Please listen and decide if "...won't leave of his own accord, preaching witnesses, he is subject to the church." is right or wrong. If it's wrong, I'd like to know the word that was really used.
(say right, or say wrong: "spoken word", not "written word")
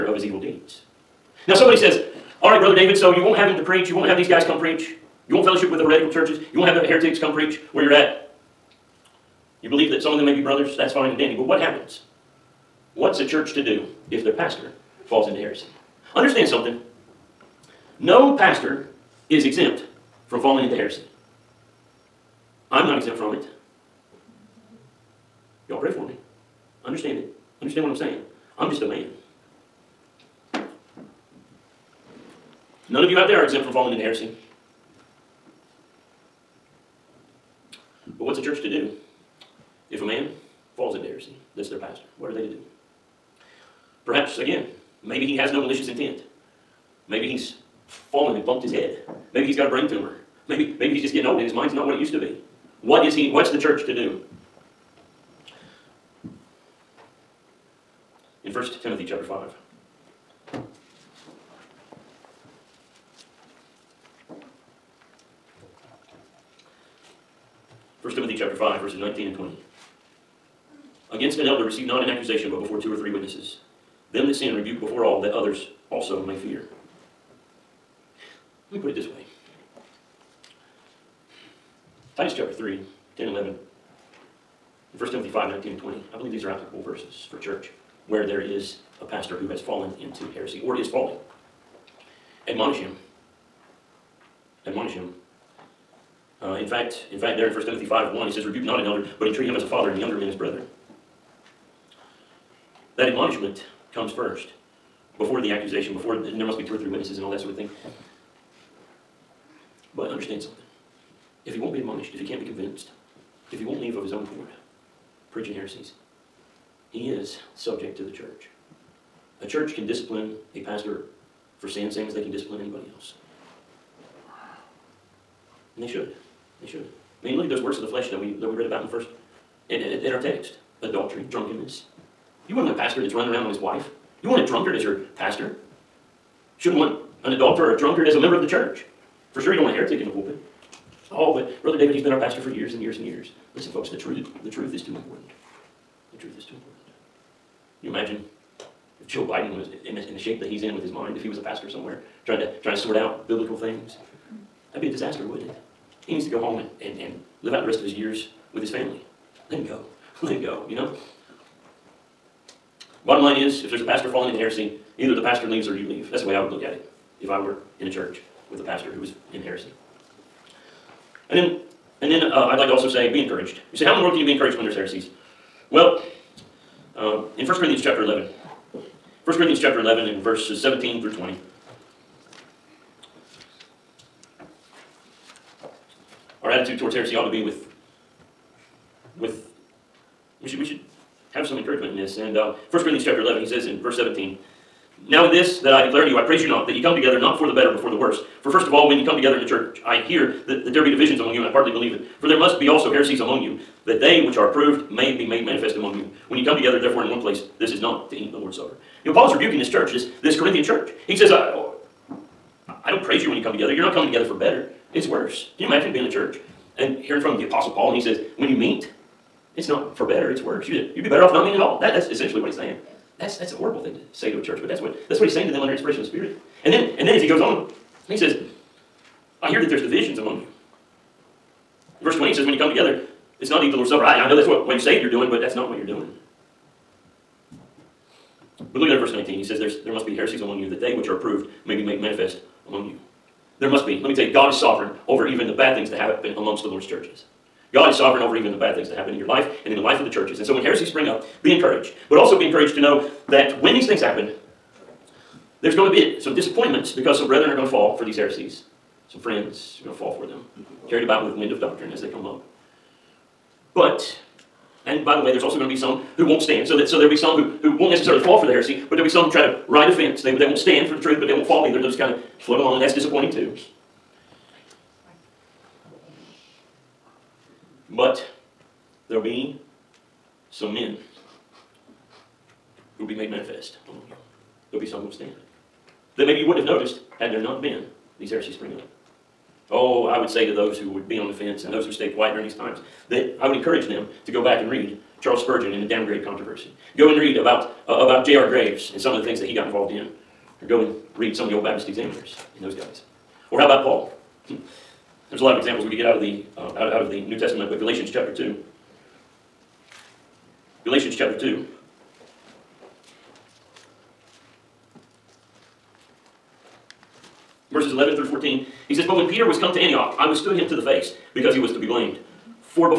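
wrong: "heresies", not "witnesses".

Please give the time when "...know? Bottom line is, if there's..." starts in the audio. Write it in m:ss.
2:40.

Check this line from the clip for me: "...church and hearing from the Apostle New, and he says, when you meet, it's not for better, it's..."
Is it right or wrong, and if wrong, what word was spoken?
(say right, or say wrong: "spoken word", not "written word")
wrong: "Paul", not "New".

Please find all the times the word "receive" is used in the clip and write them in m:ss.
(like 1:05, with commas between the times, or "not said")
1:11.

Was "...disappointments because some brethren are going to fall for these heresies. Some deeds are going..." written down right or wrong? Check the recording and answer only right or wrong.
wrong.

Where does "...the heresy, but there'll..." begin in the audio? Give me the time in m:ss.
4:28.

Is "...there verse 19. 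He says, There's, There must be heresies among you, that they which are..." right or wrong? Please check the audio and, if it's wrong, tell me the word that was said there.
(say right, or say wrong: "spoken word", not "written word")
right.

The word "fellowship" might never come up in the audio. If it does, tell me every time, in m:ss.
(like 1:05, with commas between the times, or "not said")
0:05.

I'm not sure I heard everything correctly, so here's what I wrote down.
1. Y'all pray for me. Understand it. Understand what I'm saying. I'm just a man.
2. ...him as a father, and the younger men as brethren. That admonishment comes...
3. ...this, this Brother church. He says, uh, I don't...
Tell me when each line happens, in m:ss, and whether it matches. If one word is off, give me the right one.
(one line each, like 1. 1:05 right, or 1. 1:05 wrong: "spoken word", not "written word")
1. 0:25 right
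2. 1:39 right
3. 3:29 wrong: "Corinthian", not "Brother".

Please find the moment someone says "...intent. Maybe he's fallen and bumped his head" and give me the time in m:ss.
0:45.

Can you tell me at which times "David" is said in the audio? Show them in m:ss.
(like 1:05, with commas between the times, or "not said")
0:02, 2:21.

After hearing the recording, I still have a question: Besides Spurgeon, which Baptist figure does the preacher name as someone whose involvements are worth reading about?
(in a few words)
J.R. Graves.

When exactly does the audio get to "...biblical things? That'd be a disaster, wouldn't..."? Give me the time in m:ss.
2:33.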